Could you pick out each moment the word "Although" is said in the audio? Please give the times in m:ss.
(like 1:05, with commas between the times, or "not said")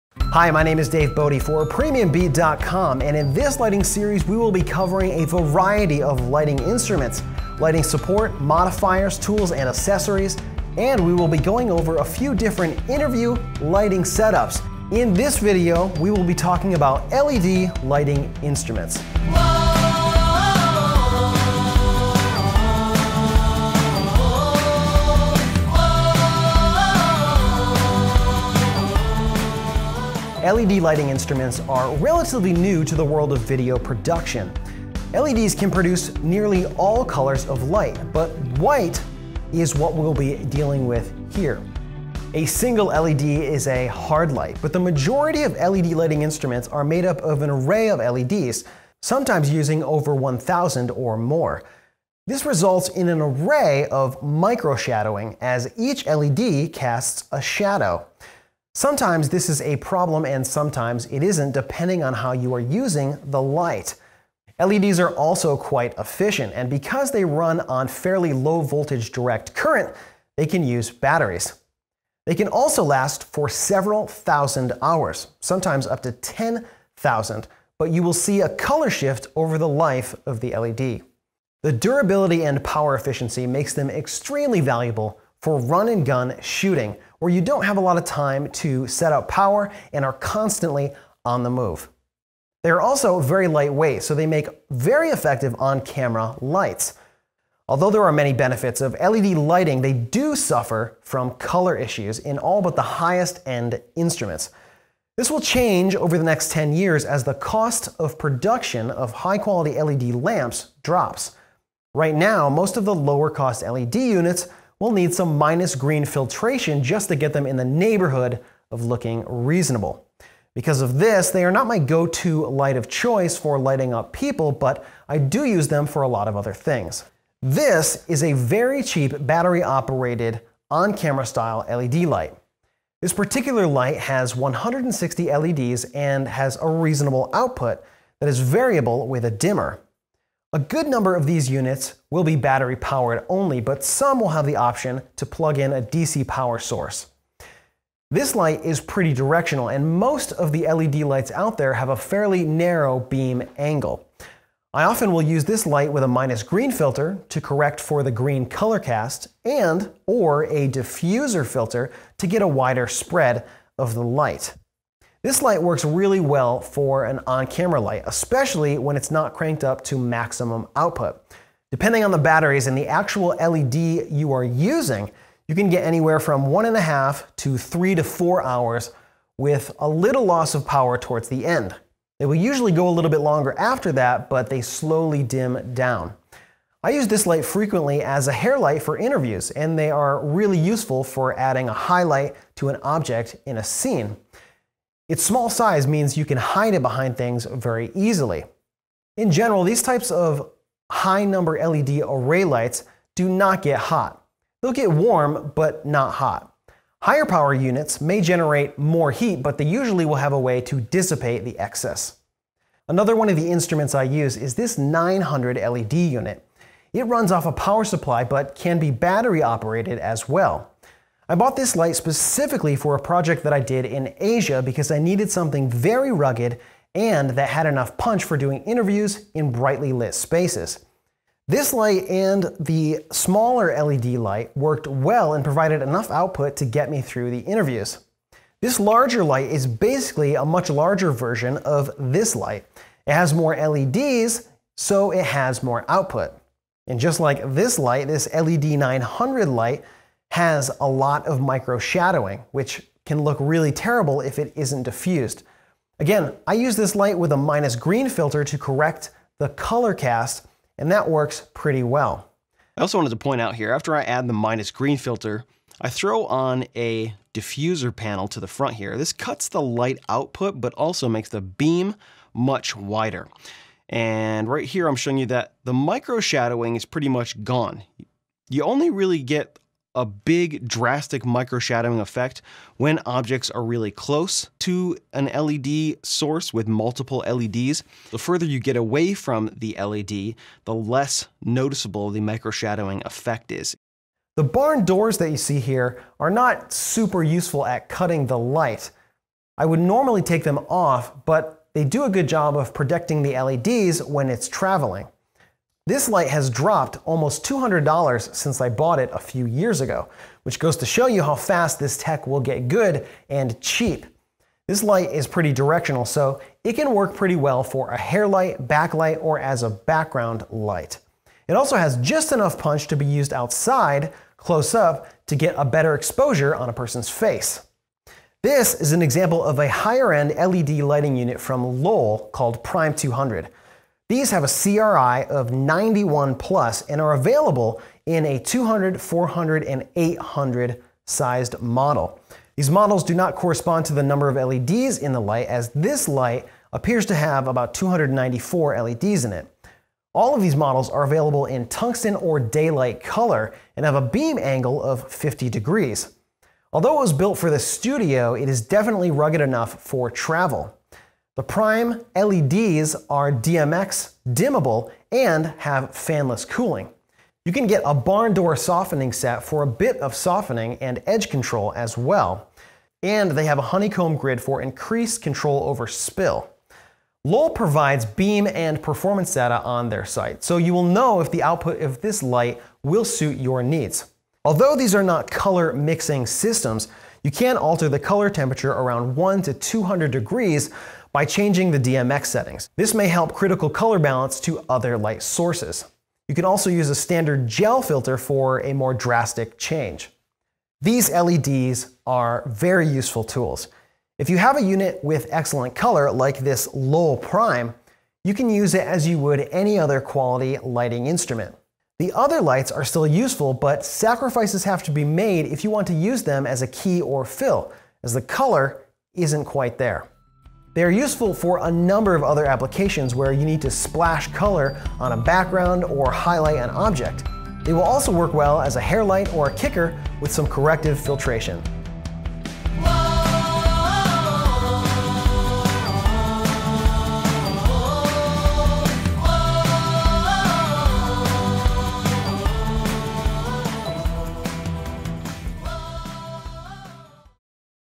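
1:37, 5:56, 6:24.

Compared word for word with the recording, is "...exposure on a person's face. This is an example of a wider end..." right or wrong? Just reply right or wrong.
wrong.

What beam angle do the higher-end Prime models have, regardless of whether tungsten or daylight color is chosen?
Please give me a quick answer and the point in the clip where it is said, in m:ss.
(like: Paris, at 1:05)
50 degrees, at 5:55.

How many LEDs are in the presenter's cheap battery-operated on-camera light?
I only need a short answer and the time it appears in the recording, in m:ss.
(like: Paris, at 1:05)
160, at 2:14.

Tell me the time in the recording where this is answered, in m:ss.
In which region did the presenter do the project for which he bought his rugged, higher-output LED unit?
3:44.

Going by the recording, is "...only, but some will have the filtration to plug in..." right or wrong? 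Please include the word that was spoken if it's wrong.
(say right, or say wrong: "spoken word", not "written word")
wrong: "option", not "filtration".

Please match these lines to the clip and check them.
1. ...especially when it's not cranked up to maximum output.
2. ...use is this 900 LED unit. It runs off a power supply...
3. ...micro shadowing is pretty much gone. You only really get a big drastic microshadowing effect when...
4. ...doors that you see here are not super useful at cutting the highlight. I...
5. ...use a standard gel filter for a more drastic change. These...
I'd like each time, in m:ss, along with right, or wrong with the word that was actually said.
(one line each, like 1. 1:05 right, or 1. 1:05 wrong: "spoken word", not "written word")
1. 2:48 right
2. 3:34 right
3. 4:35 right
4. 4:54 wrong: "light", not "highlight"
5. 6:36 right.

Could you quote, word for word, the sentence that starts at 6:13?
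And they have a honeycomb grid for increased control over spill.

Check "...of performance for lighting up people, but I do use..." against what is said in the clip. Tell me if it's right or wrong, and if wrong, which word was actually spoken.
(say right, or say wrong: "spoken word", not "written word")
wrong: "choice", not "performance".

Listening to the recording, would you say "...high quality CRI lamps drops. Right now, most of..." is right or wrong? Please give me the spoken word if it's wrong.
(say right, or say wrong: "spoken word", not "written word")
wrong: "LED", not "CRI".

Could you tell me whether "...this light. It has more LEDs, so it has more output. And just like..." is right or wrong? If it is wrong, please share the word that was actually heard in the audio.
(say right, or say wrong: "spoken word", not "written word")
right.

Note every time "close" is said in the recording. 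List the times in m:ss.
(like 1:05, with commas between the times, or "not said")
4:43, 5:24.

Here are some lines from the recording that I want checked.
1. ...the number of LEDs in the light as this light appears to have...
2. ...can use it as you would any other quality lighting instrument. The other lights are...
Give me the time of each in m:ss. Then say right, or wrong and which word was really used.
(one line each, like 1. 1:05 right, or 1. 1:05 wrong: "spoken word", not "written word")
1. 5:43 right
2. 6:48 right.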